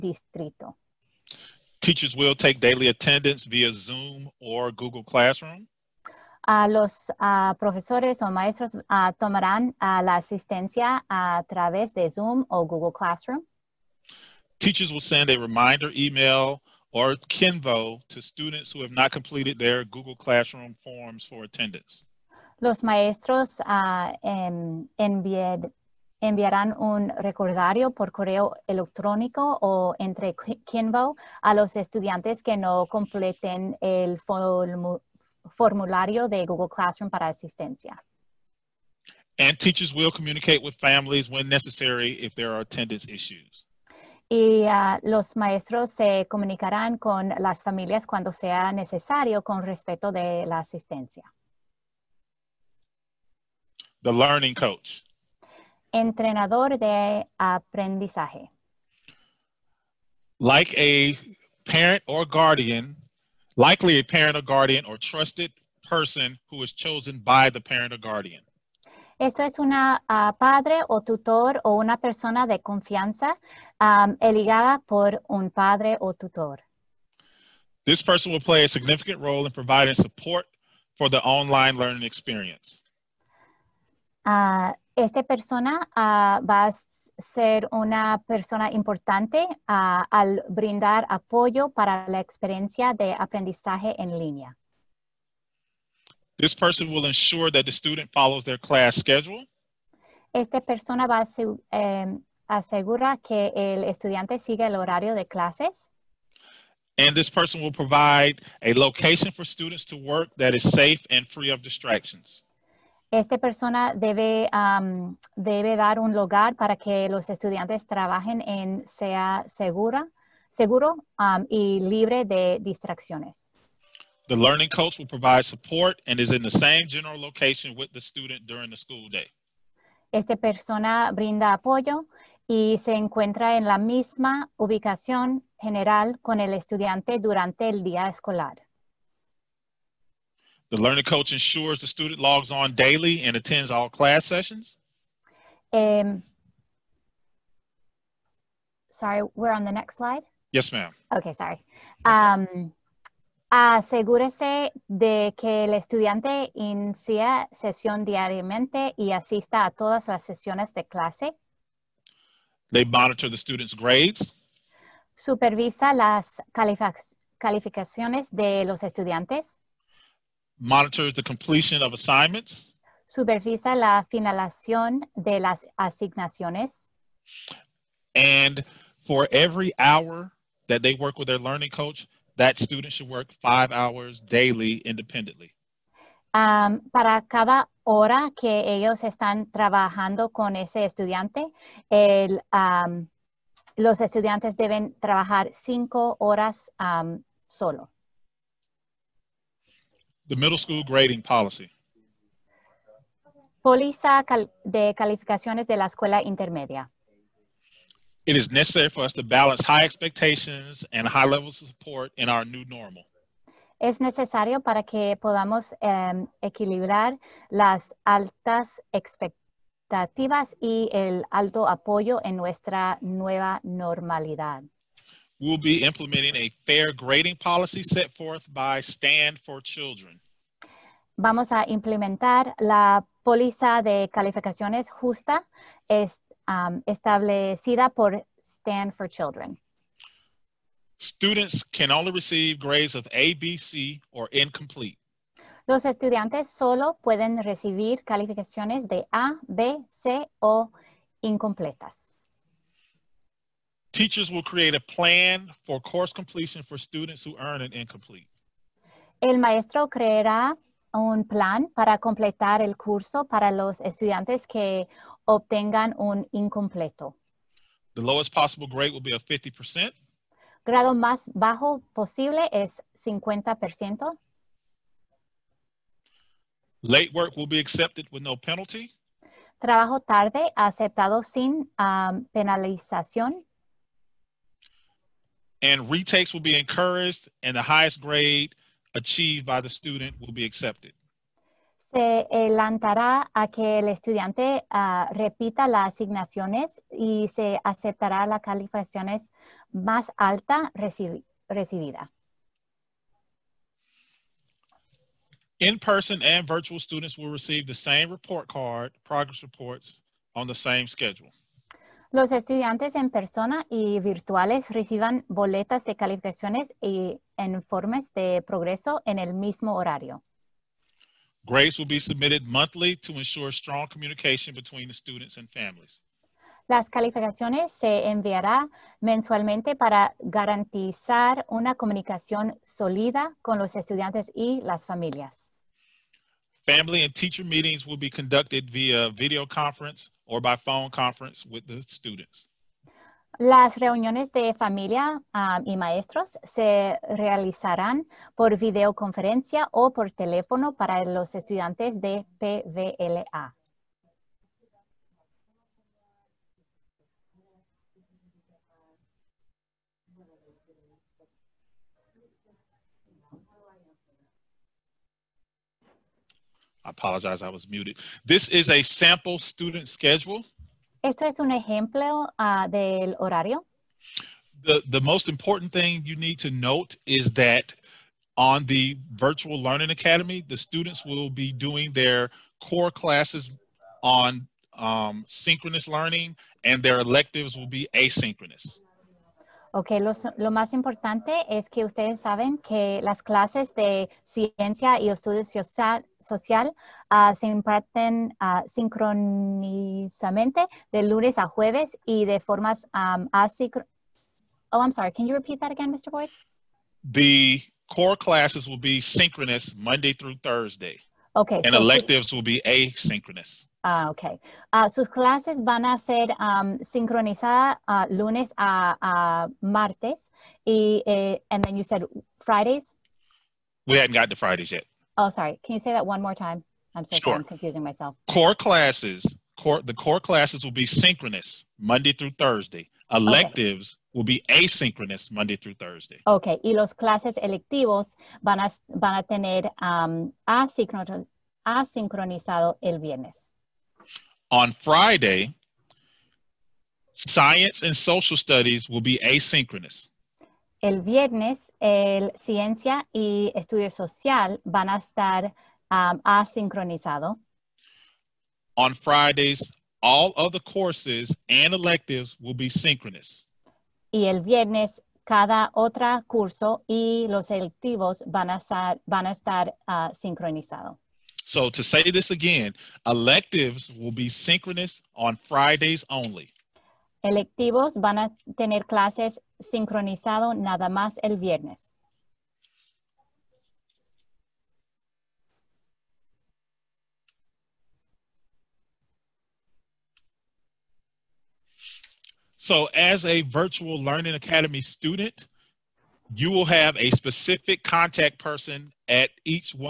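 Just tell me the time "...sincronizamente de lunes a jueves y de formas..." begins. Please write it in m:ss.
6:38.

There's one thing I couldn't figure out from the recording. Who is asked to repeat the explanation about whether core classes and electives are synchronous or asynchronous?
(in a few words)
Mr. Boyd.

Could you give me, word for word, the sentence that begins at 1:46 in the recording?
And this person will provide a location for students to work that is safe and free of distractions.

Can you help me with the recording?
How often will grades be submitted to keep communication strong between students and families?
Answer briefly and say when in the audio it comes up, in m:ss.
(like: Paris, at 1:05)
Monthly, at 5:22.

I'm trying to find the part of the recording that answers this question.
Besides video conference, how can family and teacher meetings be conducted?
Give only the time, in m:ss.
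5:40.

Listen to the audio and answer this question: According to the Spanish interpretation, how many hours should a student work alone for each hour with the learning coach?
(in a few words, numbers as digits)
5.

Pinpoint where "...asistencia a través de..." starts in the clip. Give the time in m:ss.
0:10.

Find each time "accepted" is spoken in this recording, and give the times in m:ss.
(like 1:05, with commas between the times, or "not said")
4:37, 4:50.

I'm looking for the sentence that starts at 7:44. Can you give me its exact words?
Y el viernes, cada otro curso y los electivos van a estar, van a estar uh, ah, sincronizado.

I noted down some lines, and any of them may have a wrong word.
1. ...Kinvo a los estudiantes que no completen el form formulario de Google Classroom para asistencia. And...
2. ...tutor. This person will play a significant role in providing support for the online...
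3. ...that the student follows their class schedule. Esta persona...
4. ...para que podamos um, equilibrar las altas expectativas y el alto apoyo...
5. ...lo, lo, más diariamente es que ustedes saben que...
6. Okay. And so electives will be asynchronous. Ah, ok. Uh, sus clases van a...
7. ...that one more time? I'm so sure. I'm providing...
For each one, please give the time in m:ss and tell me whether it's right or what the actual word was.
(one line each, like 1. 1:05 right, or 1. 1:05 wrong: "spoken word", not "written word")
1. 0:30 right
2. 1:16 right
3. 1:37 right
4. 3:34 right
5. 6:30 wrong: "importante", not "diariamente"
6. 6:51 right
7. 7:05 wrong: "confusing", not "providing".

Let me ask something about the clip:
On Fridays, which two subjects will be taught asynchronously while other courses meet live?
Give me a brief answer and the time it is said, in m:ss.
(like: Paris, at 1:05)
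Science and social studies, at 7:27.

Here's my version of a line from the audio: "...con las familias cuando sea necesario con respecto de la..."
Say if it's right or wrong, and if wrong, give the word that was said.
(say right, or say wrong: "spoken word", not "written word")
right.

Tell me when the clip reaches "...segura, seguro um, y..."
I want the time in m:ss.
1:59.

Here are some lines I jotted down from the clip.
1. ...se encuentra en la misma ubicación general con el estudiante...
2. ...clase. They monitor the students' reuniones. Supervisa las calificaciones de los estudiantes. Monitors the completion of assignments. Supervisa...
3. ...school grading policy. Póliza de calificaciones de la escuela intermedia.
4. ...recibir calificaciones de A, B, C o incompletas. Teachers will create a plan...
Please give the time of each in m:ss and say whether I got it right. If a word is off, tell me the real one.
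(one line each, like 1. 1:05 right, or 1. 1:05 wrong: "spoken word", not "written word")
1. 2:12 right
2. 2:40 wrong: "grades", not "reuniones"
3. 3:20 right
4. 4:07 right.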